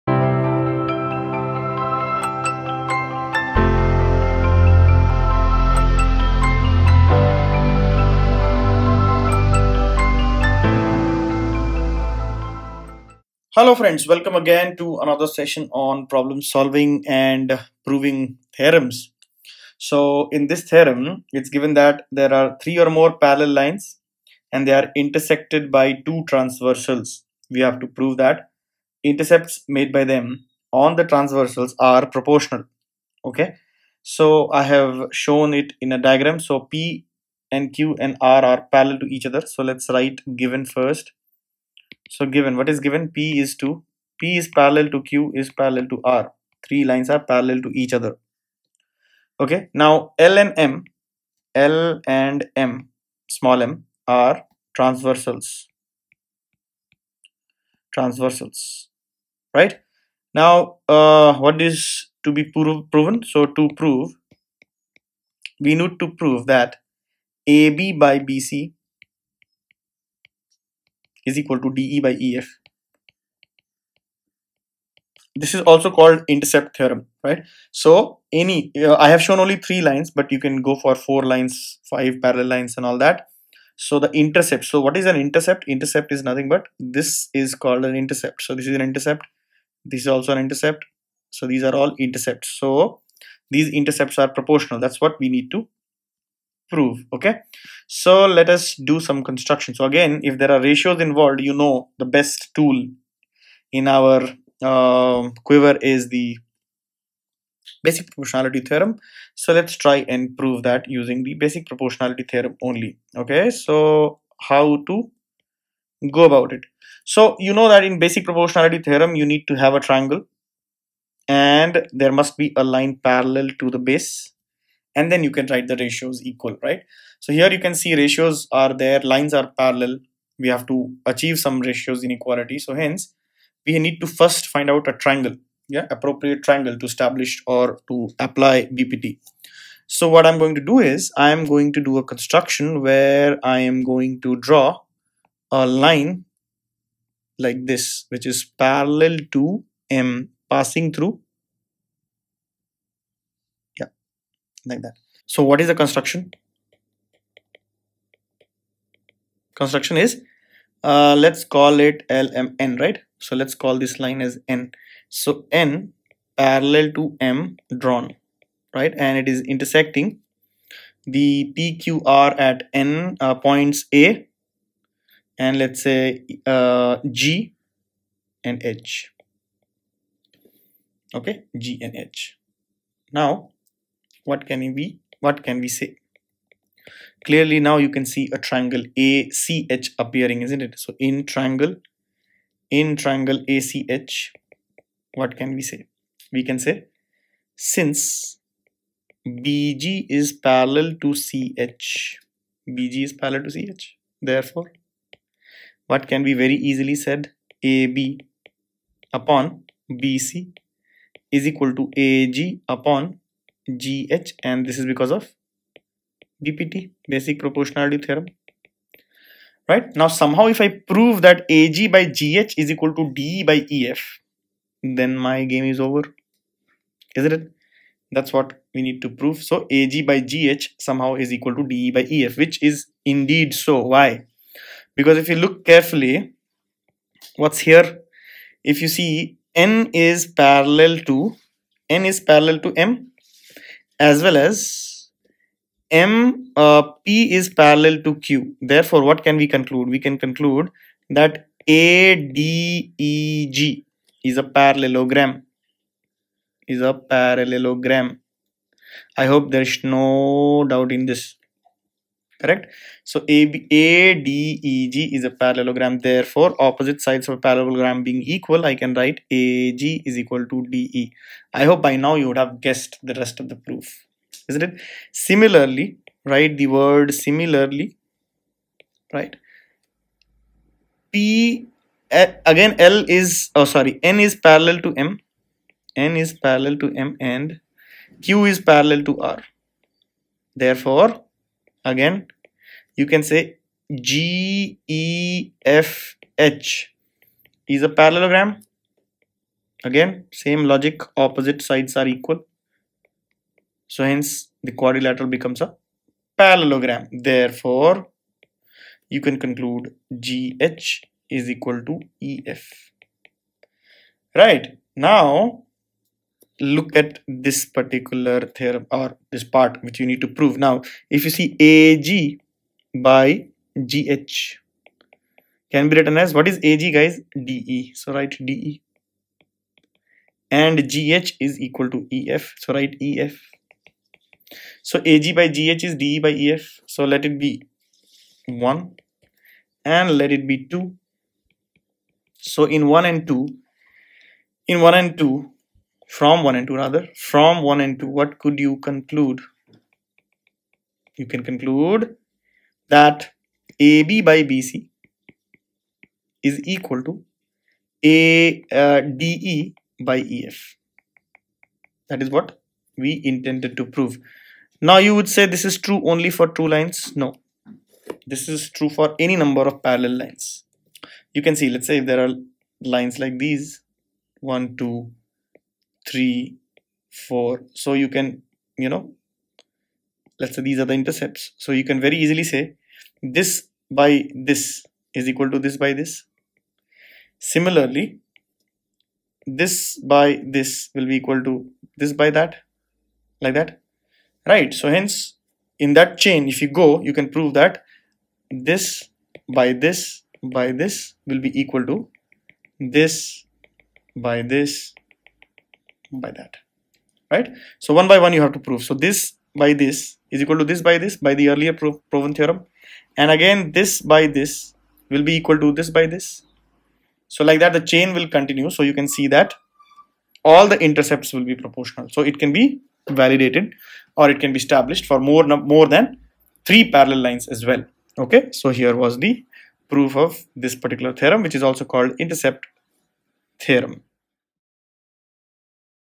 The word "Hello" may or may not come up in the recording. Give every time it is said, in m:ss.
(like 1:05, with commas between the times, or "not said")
0:13.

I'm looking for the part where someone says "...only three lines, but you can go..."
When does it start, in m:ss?
1:19.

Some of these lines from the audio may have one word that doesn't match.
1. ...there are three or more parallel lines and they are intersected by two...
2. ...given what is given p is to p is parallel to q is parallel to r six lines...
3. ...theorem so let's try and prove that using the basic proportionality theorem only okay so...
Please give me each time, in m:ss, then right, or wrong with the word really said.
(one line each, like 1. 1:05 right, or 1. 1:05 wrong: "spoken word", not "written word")
1. 0:22 right
2. 0:42 wrong: "three", not "six"
3. 1:48 right.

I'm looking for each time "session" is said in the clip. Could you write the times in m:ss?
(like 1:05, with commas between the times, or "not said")
0:15.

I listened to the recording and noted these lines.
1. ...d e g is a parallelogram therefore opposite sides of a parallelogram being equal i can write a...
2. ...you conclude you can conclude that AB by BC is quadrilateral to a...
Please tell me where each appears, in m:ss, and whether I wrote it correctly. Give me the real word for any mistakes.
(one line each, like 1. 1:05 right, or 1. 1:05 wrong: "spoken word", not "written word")
1. 4:24 right
2. 5:48 wrong: "equal", not "quadrilateral".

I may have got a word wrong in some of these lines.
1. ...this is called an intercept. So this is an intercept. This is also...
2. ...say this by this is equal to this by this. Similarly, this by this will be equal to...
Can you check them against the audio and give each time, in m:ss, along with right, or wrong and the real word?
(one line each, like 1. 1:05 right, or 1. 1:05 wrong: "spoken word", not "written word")
1. 1:26 right
2. 6:22 right.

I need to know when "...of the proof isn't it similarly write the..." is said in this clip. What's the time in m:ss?
4:33.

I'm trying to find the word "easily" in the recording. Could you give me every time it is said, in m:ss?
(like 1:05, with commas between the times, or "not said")
3:26, 6:22.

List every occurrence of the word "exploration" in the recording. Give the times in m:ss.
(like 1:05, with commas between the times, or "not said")
not said.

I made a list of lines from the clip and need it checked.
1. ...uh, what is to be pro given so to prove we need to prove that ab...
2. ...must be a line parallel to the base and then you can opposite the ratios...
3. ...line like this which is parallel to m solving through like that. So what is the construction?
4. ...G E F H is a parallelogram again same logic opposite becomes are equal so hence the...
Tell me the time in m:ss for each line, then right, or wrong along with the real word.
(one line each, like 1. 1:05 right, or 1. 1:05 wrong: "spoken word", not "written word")
1. 1:00 wrong: "proven", not "given"
2. 2:02 wrong: "write", not "opposite"
3. 2:25 wrong: "passing", not "solving"
4. 4:54 wrong: "sides", not "becomes".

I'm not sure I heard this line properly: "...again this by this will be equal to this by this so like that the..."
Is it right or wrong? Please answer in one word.
right.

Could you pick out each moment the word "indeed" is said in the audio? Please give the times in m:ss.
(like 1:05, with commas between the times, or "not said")
3:53.